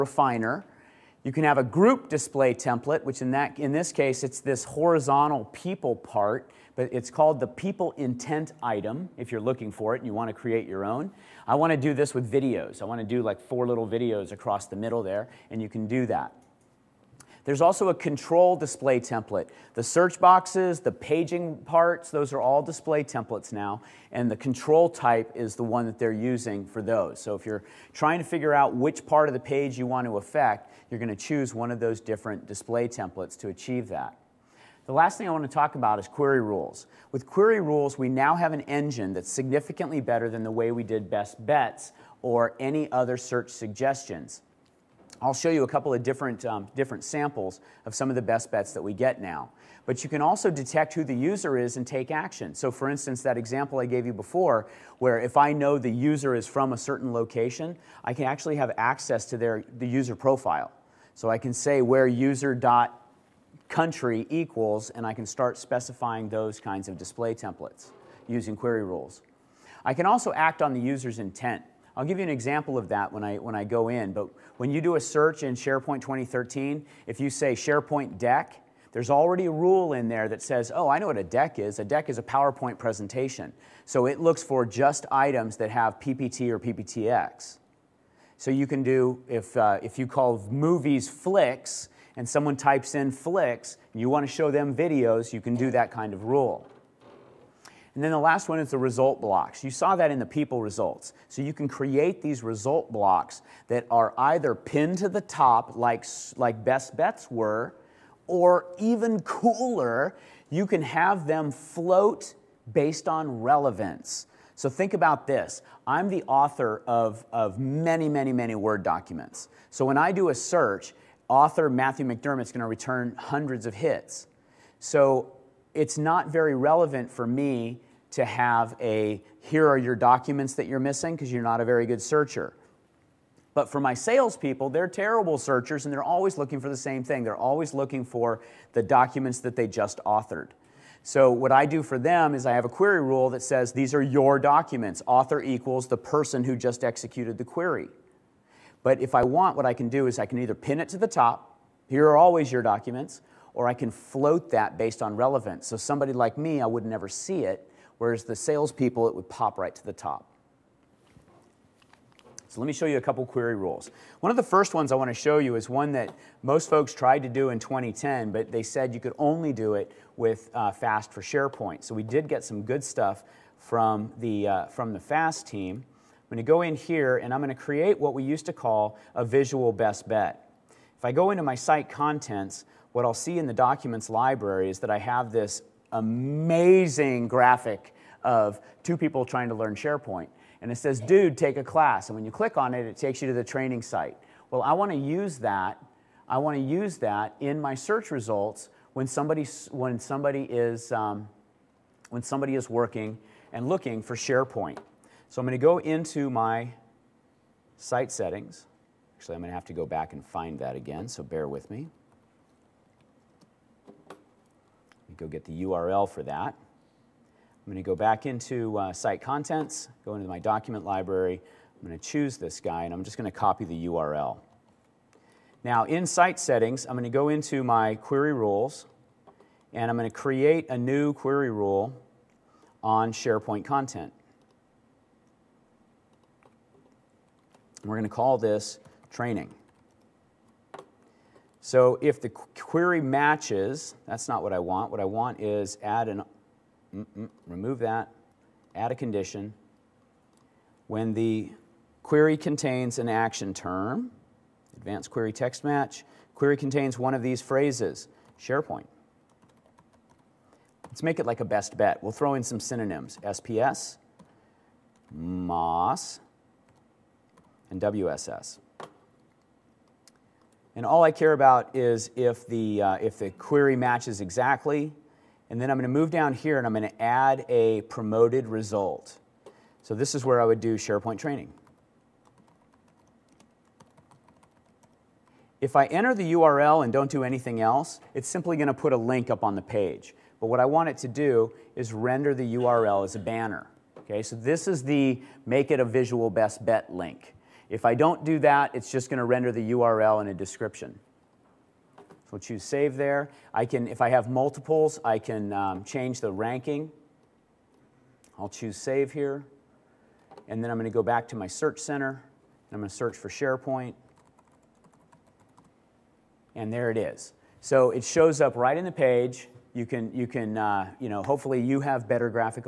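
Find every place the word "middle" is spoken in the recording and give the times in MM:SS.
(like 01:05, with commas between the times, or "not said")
00:14.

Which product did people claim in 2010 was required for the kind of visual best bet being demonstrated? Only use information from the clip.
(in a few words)
FAST for SharePoint.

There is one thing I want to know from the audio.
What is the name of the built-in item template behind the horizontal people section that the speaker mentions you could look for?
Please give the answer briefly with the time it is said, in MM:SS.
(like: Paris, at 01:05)
people intent item, at 00:07.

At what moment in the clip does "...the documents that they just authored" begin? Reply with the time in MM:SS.
02:18.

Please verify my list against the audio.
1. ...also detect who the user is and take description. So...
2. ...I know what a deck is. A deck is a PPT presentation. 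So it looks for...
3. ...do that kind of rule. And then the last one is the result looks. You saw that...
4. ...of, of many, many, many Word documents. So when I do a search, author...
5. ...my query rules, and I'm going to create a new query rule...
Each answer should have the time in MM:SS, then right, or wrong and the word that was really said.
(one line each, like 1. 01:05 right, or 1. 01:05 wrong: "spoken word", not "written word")
1. 00:50 wrong: "action", not "description"
2. 01:20 wrong: "PowerPoint", not "PPT"
3. 01:35 wrong: "blocks", not "looks"
4. 01:56 right
5. 03:47 right.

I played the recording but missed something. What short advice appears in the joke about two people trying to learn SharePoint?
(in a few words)
Dude, take a class.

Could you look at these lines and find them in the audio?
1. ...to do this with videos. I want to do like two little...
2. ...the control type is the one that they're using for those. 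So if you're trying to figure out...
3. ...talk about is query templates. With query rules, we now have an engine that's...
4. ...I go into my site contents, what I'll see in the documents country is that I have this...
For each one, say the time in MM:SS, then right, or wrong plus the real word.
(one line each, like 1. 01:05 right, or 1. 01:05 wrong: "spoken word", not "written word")
1. 00:11 wrong: "four", not "two"
2. 00:24 right
3. 00:35 wrong: "rules", not "templates"
4. 03:01 wrong: "library", not "country".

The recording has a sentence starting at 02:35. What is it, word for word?
So somebody like me, I would never see it, whereas the salespeople, it would pop right to the top.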